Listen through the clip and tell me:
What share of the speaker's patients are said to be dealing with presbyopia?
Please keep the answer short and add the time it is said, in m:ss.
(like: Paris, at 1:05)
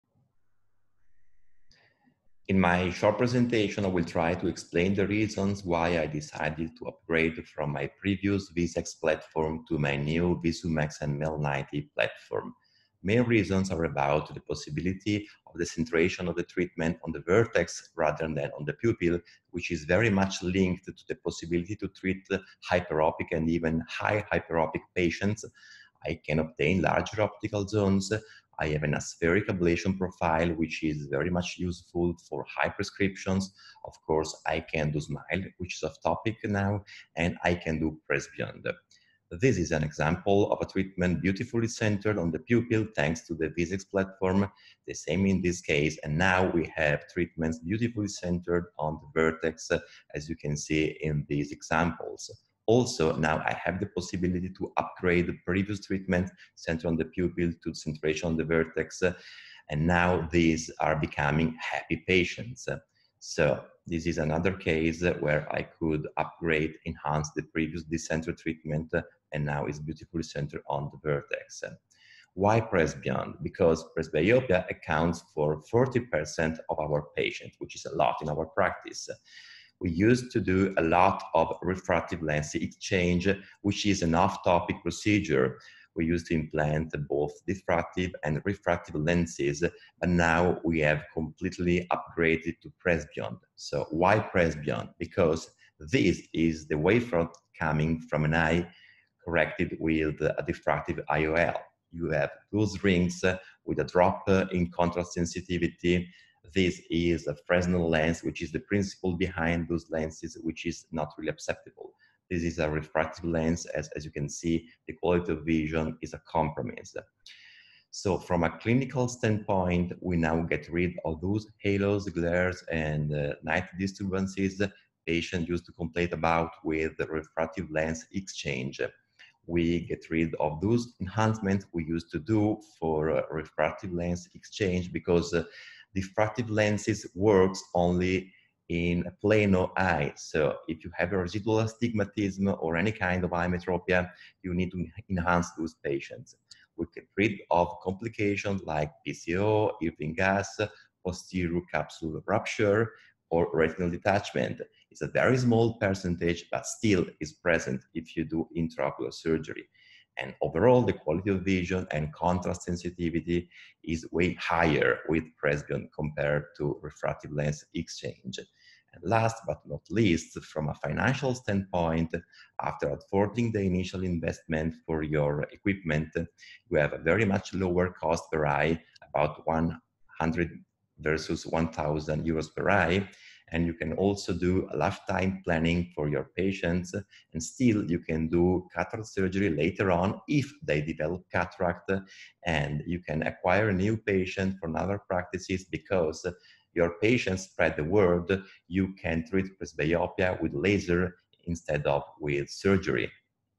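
40%, at 1:15.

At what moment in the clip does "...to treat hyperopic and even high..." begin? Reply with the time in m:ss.
0:21.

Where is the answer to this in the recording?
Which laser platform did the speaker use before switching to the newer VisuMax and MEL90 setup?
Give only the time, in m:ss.
0:08.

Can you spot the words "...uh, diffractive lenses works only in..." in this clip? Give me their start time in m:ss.
2:15.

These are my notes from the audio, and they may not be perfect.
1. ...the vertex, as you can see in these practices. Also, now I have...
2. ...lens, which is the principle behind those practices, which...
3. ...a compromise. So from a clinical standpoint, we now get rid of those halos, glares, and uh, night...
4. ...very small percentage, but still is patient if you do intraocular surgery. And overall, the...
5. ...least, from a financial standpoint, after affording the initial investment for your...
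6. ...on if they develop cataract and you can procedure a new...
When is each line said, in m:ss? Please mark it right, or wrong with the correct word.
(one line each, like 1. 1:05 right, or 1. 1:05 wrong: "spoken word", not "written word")
1. 0:49 wrong: "examples", not "practices"
2. 1:47 wrong: "lenses", not "practices"
3. 1:56 right
4. 2:35 wrong: "present", not "patient"
5. 2:49 right
6. 3:09 wrong: "acquire", not "procedure".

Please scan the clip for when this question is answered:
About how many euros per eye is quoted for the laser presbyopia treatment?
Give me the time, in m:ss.
2:59.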